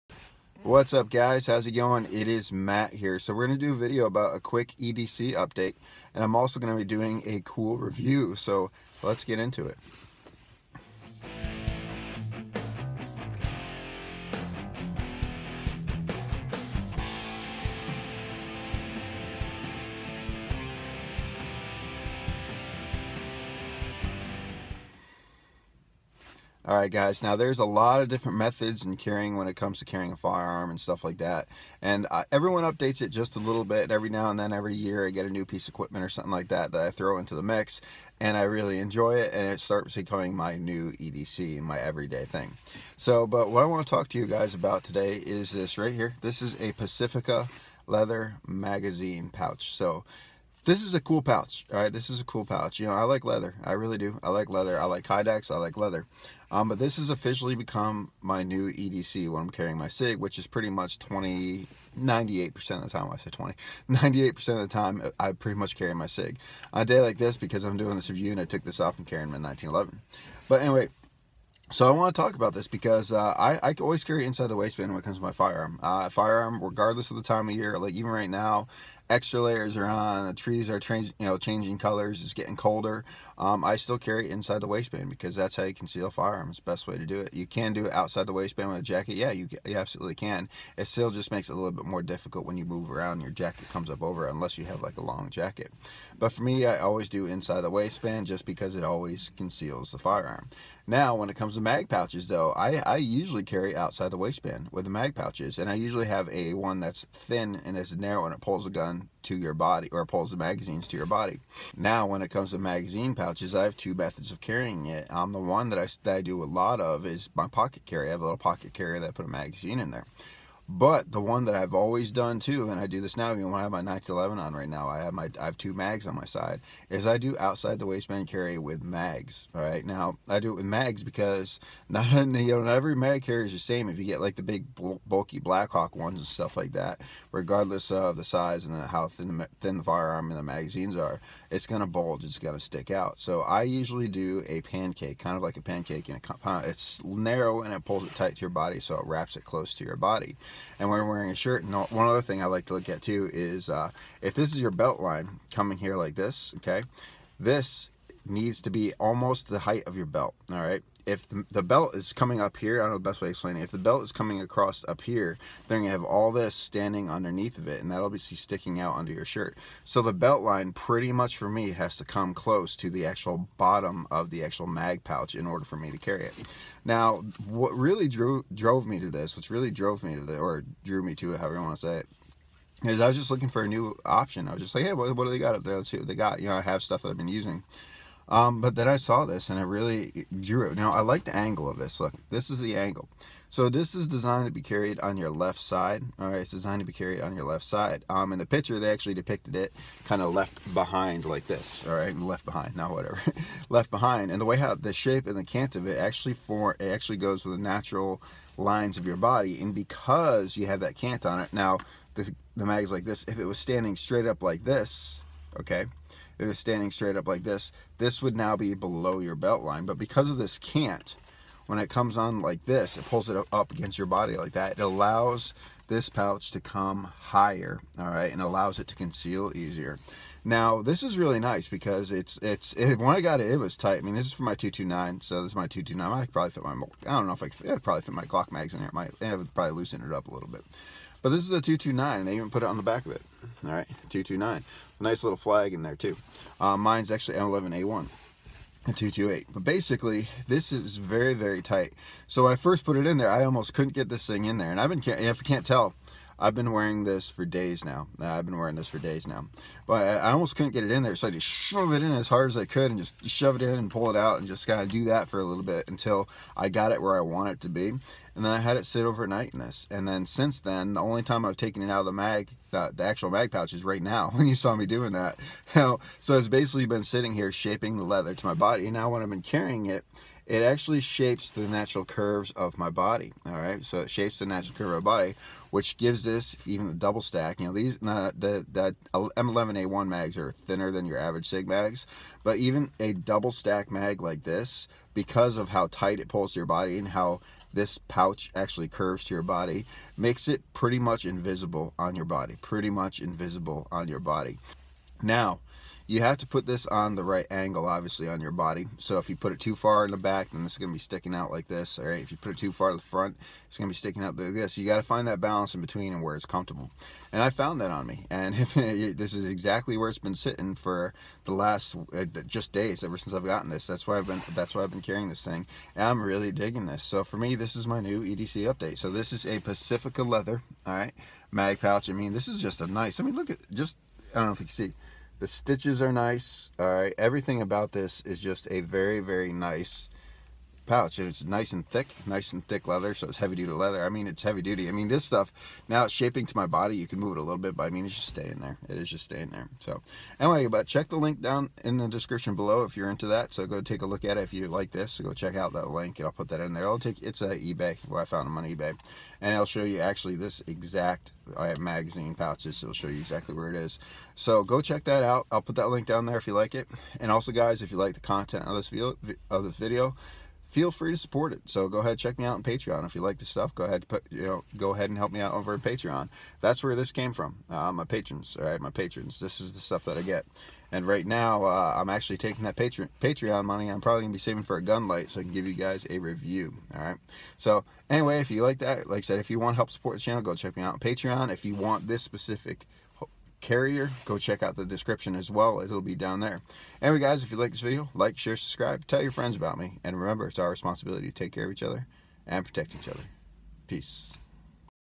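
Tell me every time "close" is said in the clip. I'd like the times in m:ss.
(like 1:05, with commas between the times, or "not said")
2:29, 2:52.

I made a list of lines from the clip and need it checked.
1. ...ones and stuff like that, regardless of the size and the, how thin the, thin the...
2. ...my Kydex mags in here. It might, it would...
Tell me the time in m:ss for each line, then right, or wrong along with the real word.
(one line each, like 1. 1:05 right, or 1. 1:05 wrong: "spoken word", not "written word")
1. 2:15 right
2. 3:58 wrong: "Glock", not "Kydex".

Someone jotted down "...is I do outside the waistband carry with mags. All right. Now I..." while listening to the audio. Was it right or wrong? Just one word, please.
right.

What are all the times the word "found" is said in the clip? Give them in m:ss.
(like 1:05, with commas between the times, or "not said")
5:17, 5:58.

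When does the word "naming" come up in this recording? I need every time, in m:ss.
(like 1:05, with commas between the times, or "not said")
not said.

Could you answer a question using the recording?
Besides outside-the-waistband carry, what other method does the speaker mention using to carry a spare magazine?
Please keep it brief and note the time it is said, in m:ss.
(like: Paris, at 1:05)
Pocket carry, at 1:57.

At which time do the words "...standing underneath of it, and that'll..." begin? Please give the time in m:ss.
2:46.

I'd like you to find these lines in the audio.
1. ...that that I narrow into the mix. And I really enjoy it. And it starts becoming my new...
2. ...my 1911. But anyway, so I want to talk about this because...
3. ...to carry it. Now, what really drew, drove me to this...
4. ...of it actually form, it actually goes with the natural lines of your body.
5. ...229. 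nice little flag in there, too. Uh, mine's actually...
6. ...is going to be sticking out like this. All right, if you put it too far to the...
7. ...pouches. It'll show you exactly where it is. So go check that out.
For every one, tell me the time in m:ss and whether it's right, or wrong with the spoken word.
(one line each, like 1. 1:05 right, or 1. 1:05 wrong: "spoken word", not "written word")
1. 0:36 wrong: "throw", not "narrow"
2. 1:09 right
3. 2:55 right
4. 3:25 right
5. 4:04 right
6. 5:10 right
7. 6:02 right.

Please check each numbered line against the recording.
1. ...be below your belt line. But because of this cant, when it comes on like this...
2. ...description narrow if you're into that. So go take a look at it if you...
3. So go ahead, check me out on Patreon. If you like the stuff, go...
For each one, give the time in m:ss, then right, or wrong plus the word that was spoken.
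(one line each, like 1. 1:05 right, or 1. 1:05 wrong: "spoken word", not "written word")
1. 3:38 right
2. 5:52 wrong: "below", not "narrow"
3. 6:11 right.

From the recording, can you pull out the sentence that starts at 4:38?
And now when I've been carrying it, it actually shapes the natural curves of my body.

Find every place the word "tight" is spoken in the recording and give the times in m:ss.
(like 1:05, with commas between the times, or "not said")
2:28, 3:53, 4:11, 4:55.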